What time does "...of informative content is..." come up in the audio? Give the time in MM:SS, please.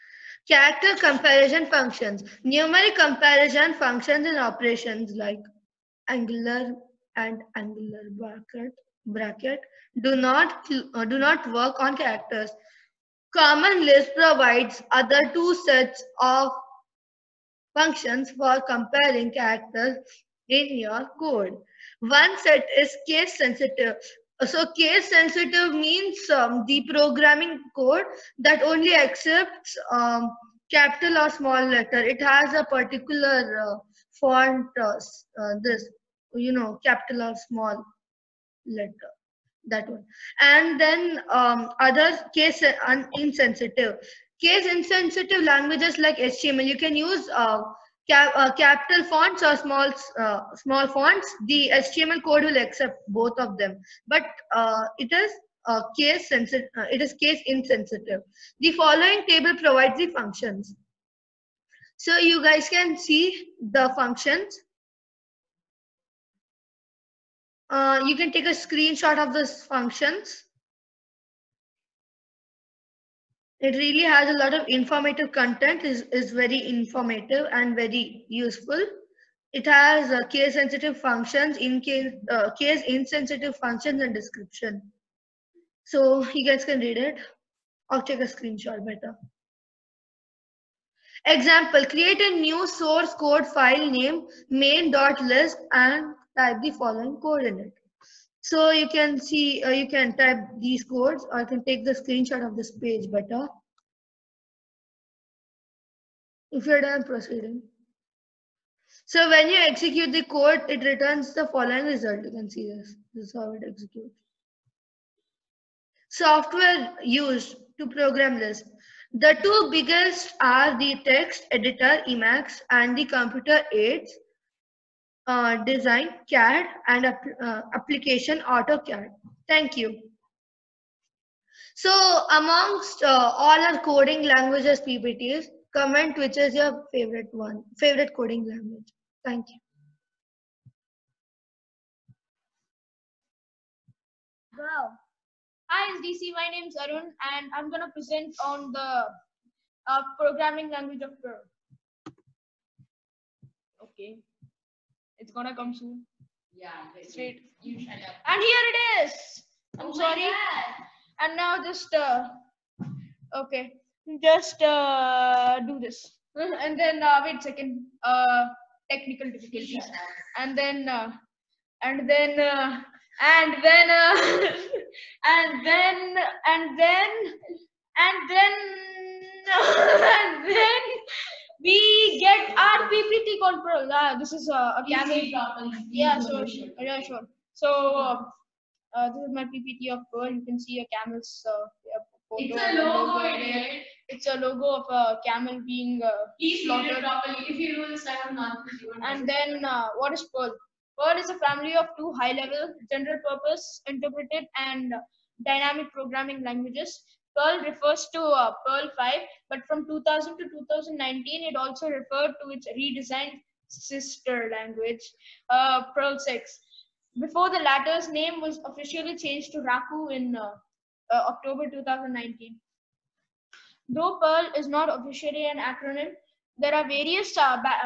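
01:14.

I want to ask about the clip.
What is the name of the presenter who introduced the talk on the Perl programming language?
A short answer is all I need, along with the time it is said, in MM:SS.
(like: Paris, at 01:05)
Arun, at 02:26.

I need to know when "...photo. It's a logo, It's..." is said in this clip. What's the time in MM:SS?
03:12.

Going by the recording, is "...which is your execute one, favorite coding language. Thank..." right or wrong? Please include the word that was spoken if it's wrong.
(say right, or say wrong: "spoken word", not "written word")
wrong: "favorite", not "execute".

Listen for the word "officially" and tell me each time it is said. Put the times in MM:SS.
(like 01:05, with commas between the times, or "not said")
03:38, 03:44.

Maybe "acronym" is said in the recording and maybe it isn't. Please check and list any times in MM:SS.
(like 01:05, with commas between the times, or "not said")
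03:45.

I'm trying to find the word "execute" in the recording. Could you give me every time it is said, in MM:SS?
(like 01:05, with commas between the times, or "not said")
01:49, 01:53.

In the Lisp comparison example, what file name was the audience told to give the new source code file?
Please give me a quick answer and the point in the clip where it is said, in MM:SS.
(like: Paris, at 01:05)
main.lisp, at 01:34.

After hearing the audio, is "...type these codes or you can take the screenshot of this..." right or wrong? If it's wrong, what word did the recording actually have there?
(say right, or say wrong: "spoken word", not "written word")
right.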